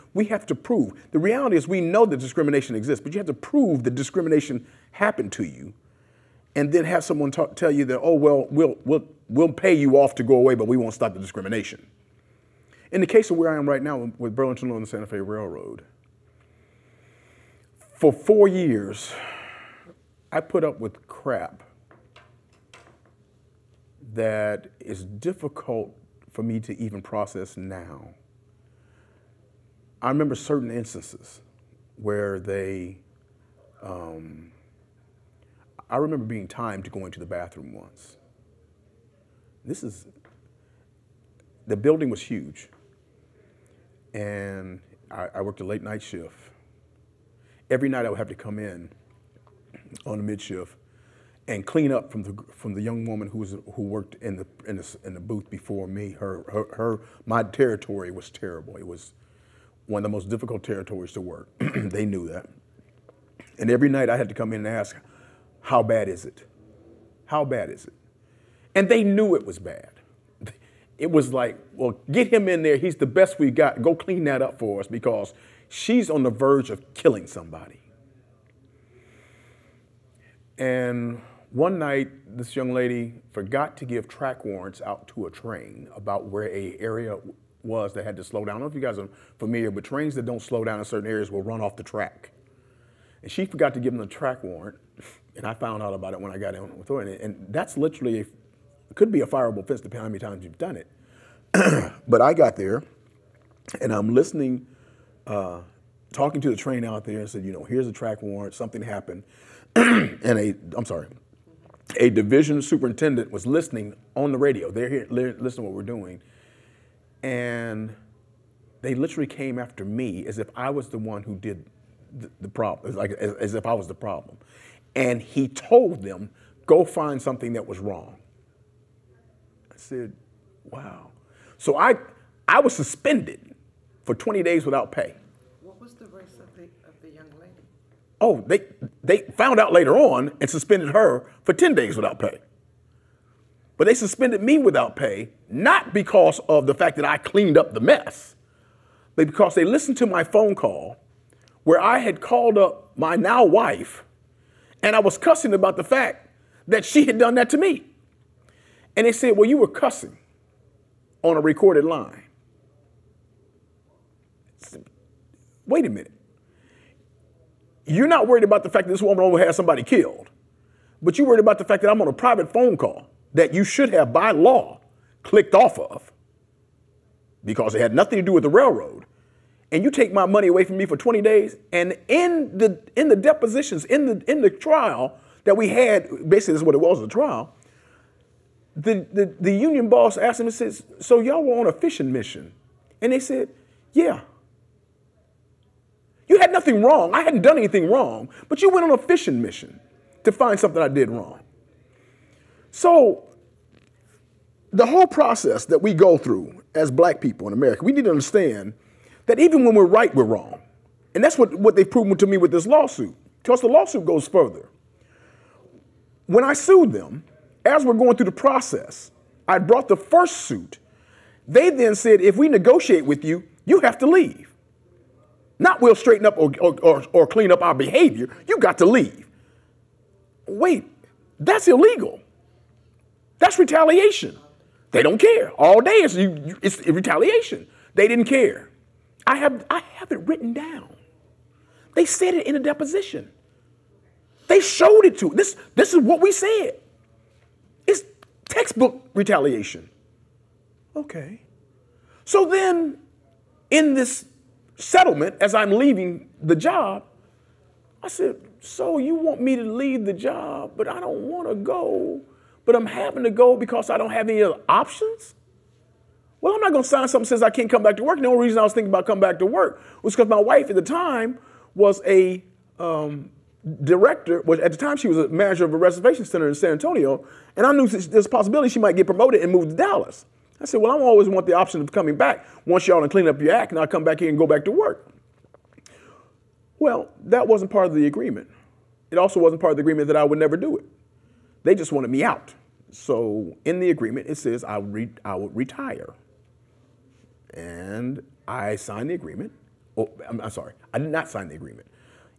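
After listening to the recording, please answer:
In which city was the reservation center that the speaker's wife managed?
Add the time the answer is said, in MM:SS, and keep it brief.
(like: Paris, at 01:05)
San Antonio, at 04:36.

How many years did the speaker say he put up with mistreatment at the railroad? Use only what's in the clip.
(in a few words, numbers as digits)
4.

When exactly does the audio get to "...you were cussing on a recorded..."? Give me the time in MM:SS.
02:39.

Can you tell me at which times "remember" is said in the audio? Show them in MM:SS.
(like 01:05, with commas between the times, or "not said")
00:30, 00:35.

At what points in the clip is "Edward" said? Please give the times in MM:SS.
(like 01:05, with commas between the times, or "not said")
not said.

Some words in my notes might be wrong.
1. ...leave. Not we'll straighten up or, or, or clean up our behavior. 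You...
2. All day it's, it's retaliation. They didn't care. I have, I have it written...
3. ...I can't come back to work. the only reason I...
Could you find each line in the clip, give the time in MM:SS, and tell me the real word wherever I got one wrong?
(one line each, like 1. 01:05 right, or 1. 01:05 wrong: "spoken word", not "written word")
1. 03:44 right
2. 03:55 right
3. 04:27 right.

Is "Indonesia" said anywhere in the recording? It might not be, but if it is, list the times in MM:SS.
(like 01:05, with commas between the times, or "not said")
not said.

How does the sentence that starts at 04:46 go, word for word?
Well, that wasn't part of the agreement.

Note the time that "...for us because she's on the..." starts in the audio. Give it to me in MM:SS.
01:14.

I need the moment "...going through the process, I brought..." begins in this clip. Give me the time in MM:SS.
03:37.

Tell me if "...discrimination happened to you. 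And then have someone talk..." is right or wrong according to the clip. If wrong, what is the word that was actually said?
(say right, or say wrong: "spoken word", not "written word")
right.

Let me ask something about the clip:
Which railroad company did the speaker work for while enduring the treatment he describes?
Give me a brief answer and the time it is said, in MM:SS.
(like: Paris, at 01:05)
Burlington Northern Santa Fe Railroad, at 00:14.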